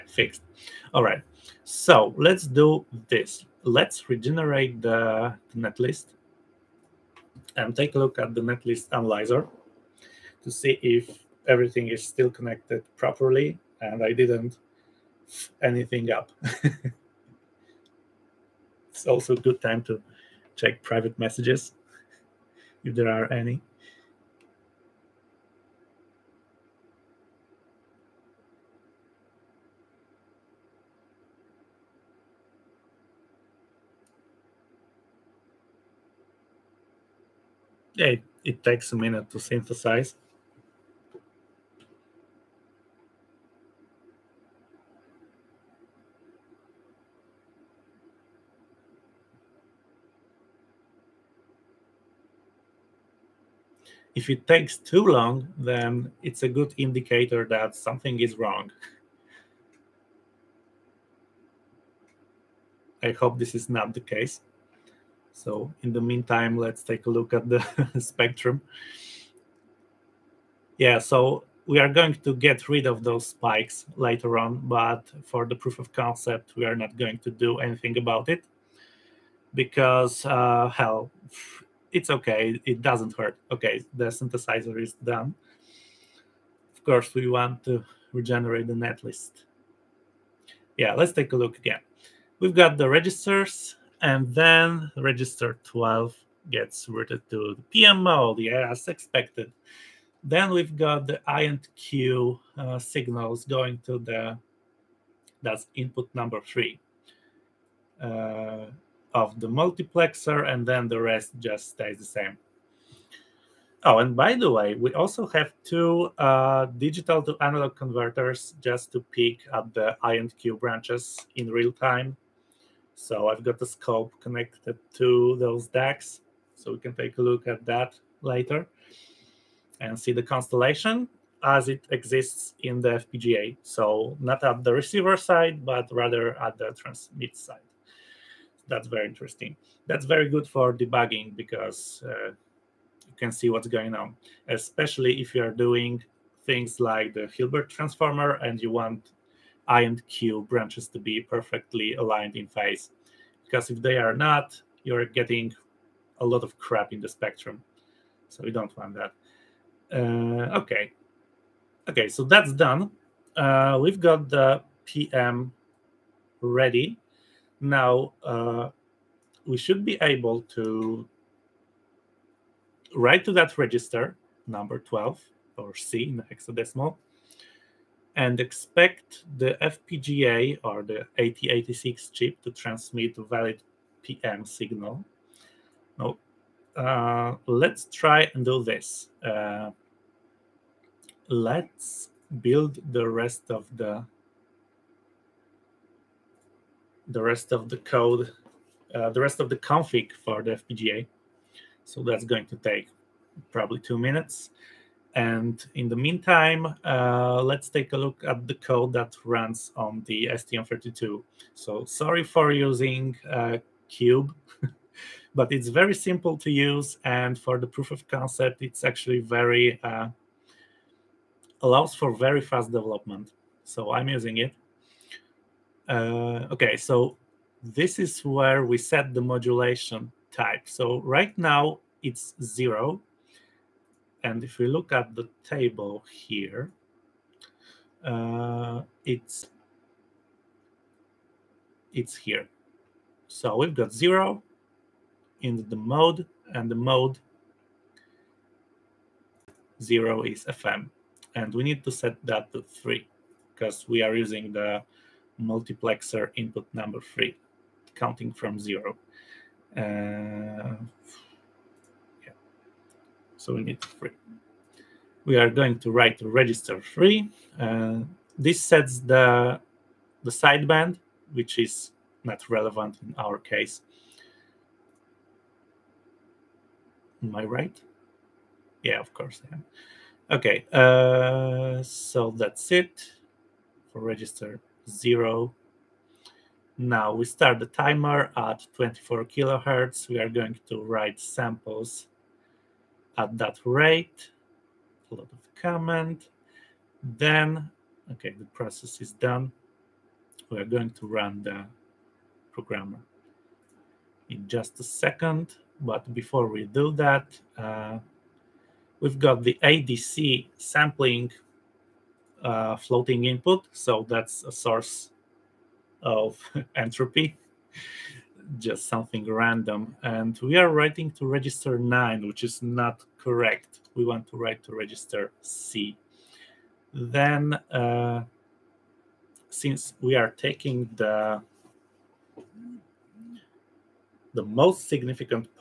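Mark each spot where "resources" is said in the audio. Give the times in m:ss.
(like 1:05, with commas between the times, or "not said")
not said.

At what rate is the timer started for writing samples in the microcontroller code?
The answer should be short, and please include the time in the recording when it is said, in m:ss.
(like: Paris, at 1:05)
24 kilohertz, at 4:48.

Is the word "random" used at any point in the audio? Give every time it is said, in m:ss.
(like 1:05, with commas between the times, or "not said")
5:19.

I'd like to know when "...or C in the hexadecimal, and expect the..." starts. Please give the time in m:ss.
2:55.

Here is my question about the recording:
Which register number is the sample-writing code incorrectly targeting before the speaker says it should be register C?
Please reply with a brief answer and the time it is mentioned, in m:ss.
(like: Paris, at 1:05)
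9, at 5:21.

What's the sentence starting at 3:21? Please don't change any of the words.
So that's going to take probably two minutes.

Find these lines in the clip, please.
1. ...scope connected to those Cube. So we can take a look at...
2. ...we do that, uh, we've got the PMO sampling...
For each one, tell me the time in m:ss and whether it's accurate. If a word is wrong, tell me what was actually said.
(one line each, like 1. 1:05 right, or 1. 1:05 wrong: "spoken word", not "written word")
1. 2:03 wrong: "DACs", not "Cube"
2. 5:06 wrong: "ADC", not "PMO".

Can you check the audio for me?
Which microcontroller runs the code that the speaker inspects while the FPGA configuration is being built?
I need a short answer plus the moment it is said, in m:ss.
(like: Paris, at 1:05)
STM32, at 3:30.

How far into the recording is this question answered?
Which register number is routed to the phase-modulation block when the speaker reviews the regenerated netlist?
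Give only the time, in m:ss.
1:34.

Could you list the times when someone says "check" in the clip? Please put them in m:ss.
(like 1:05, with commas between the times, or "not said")
0:20.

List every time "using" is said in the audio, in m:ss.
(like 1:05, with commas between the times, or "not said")
3:32, 3:44, 4:14.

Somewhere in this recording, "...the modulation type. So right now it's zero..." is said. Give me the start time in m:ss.
3:49.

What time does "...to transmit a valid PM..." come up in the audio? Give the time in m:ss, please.
3:02.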